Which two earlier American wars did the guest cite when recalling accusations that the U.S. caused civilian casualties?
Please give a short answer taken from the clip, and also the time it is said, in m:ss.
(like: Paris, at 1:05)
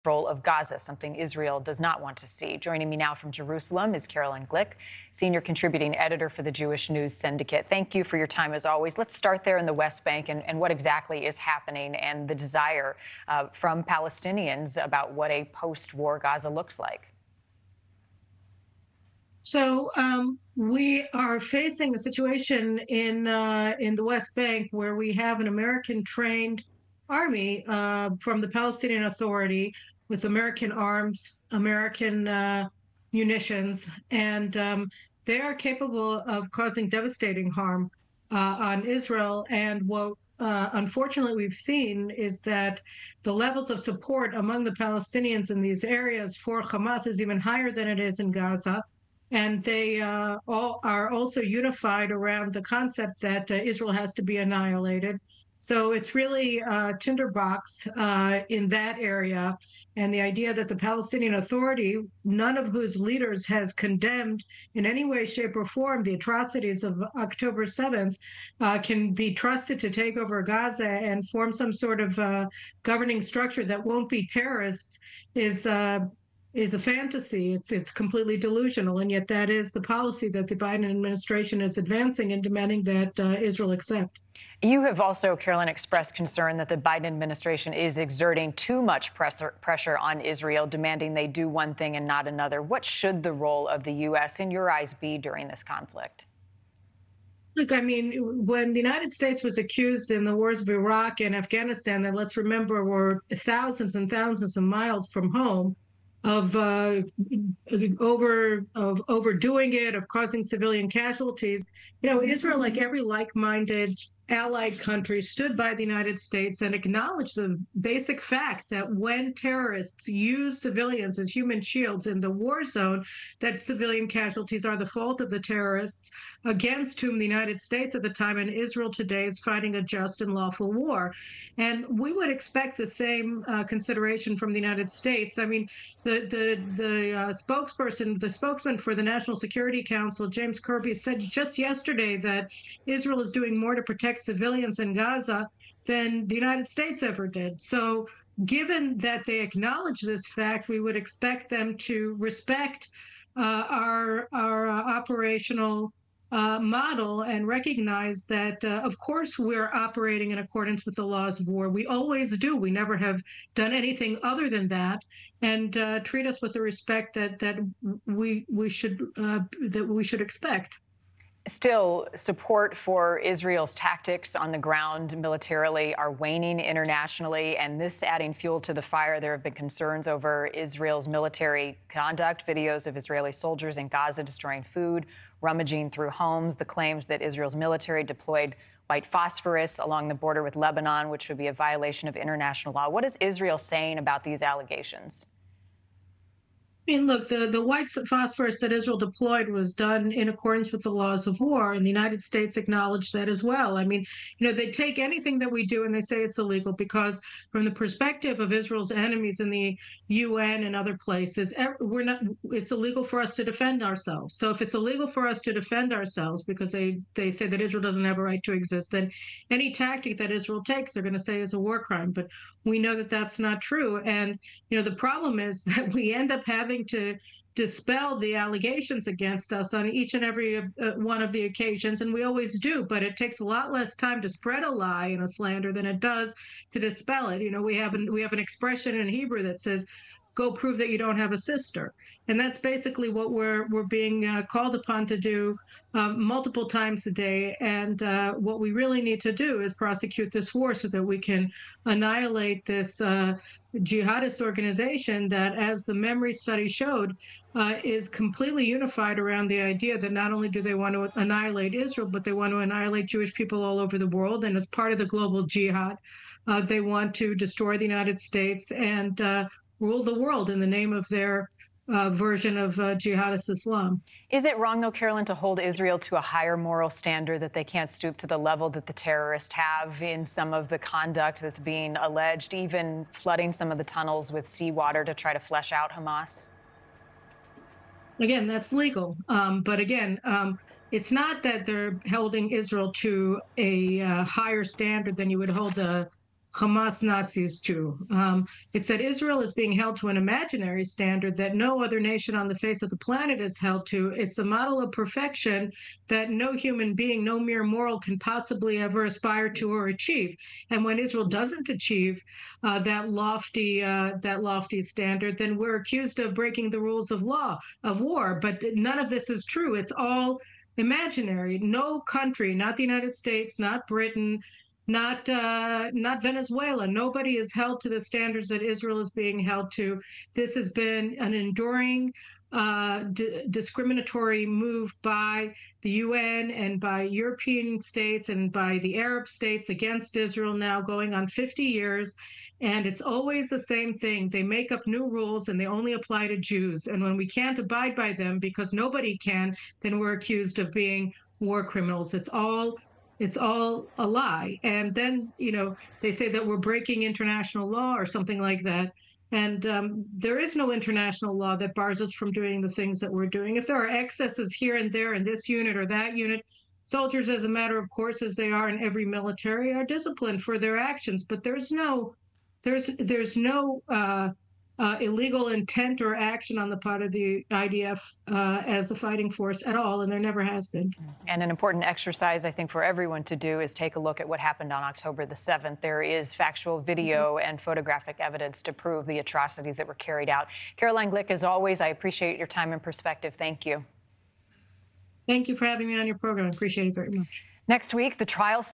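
Iraq and Afghanistan, at 1:40.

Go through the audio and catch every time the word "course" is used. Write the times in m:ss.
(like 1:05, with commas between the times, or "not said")
2:38, 6:07.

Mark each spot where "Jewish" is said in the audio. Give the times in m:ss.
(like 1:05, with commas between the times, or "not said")
0:06, 4:23.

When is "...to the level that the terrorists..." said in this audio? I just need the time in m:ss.
4:38.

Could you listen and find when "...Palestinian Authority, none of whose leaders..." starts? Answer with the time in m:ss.
1:00.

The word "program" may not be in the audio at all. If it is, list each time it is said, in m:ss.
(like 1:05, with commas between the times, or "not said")
6:36.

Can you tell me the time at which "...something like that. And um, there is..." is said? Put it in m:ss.
5:58.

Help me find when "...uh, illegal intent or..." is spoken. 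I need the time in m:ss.
6:14.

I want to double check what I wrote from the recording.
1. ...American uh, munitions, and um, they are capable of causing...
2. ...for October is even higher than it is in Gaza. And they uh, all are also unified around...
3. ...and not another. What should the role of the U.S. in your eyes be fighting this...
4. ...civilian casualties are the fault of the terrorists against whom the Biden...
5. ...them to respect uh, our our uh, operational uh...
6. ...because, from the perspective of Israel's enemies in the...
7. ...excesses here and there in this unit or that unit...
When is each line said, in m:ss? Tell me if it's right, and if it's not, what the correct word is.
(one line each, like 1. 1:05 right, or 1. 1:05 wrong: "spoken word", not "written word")
1. 0:31 right
2. 0:46 wrong: "Hamas", not "October"
3. 1:31 wrong: "during", not "fighting"
4. 2:03 wrong: "United", not "Biden"
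5. 2:31 right
6. 3:26 right
7. 6:03 right.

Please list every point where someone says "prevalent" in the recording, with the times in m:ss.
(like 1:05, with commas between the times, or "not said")
not said.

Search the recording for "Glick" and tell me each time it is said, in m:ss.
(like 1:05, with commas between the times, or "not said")
0:04, 6:31.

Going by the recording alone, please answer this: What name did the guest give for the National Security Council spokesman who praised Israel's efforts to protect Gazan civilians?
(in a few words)
James Kirby.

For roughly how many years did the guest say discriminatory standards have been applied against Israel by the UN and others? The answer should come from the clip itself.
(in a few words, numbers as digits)
50 years.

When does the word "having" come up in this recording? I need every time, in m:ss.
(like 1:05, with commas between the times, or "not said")
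3:46, 6:35.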